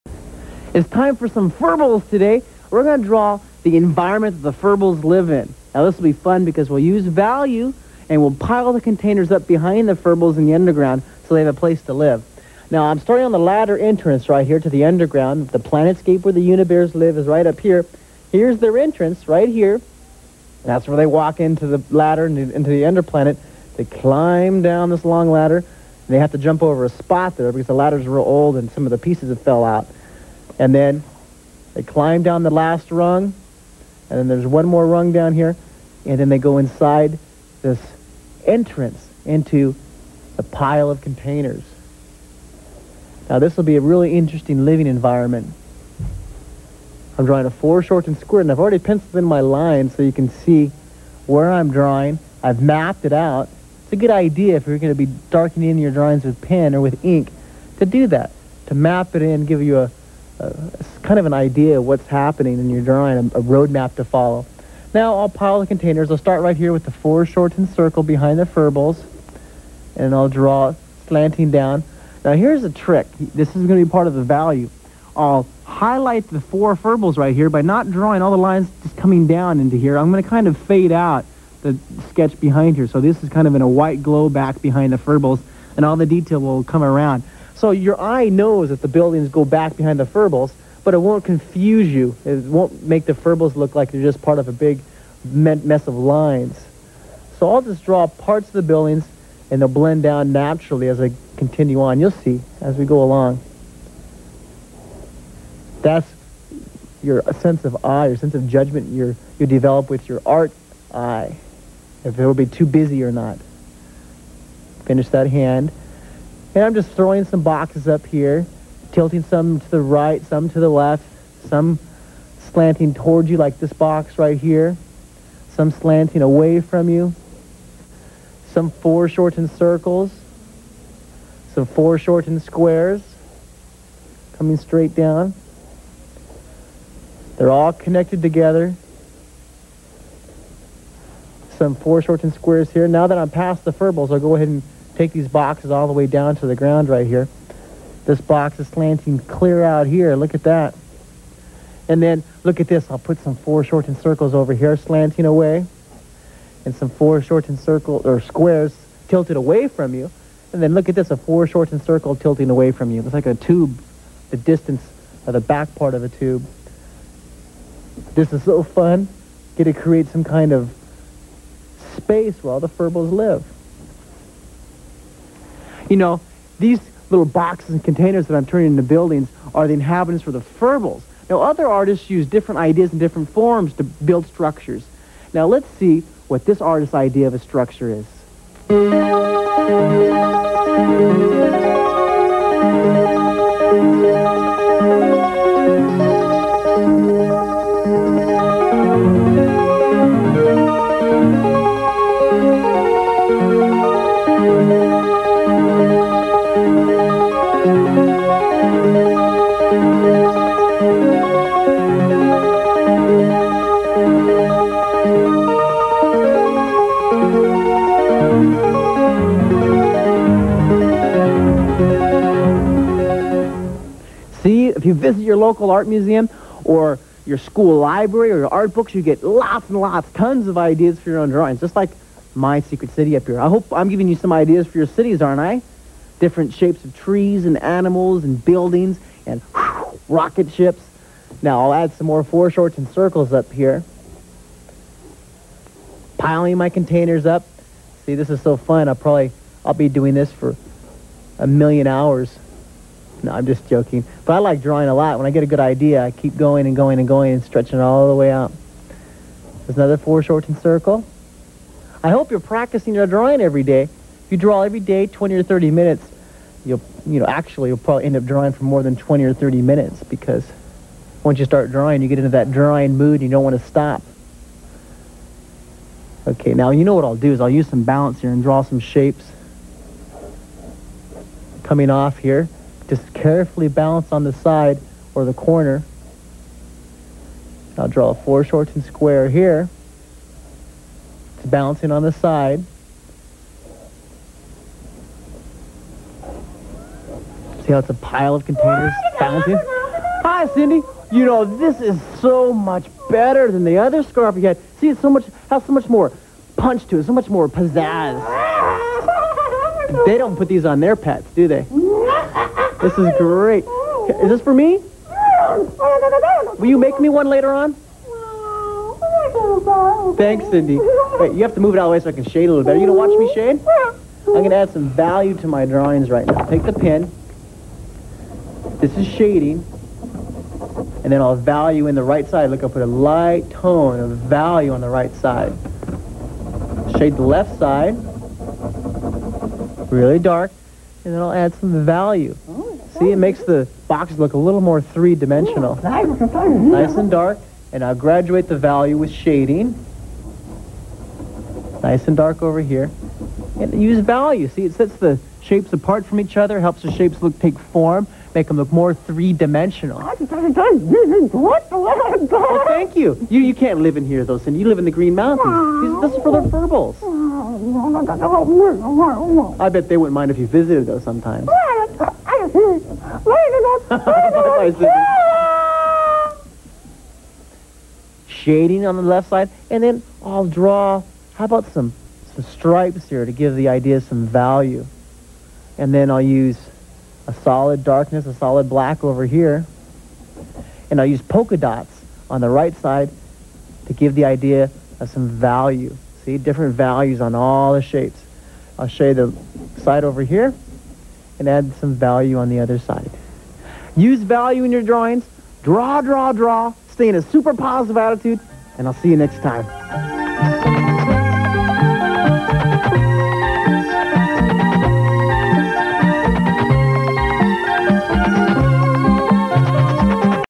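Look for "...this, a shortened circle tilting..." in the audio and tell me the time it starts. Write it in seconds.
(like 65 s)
160 s.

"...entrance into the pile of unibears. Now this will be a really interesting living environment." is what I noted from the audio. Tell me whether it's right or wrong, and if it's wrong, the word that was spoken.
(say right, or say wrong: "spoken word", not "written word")
wrong: "containers", not "unibears".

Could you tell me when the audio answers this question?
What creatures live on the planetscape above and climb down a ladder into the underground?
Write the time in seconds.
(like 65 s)
16 s.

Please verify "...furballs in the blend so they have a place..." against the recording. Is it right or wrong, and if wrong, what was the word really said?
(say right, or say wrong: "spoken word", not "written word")
wrong: "underground", not "blend".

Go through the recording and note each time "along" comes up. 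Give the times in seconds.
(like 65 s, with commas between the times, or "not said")
103 s.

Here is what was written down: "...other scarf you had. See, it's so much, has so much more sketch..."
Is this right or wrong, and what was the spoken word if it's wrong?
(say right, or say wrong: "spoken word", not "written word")
wrong: "punch", not "sketch".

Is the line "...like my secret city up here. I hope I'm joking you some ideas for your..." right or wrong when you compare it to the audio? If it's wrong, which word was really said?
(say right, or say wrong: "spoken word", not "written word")
wrong: "giving", not "joking".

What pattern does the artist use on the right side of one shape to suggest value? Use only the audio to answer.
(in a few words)
polka dots.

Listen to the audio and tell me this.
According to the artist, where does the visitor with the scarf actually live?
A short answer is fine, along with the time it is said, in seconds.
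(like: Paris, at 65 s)
the Green Mountains, at 364 s.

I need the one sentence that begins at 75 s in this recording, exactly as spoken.
I'll highlight the four furballs right here by not drawing all the lines just coming down into here.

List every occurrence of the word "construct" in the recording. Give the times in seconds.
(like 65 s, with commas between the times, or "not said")
not said.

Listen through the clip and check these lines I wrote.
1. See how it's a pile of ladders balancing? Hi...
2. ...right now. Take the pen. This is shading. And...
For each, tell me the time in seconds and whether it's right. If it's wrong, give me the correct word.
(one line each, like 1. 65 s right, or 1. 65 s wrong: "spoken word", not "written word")
1. 297 s wrong: "containers", not "ladders"
2. 326 s right.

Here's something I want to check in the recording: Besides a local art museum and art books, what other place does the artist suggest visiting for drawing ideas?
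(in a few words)
school library.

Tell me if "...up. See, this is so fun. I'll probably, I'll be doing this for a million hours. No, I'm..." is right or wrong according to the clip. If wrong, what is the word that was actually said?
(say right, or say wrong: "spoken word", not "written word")
right.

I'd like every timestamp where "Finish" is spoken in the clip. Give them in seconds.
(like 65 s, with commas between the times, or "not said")
114 s.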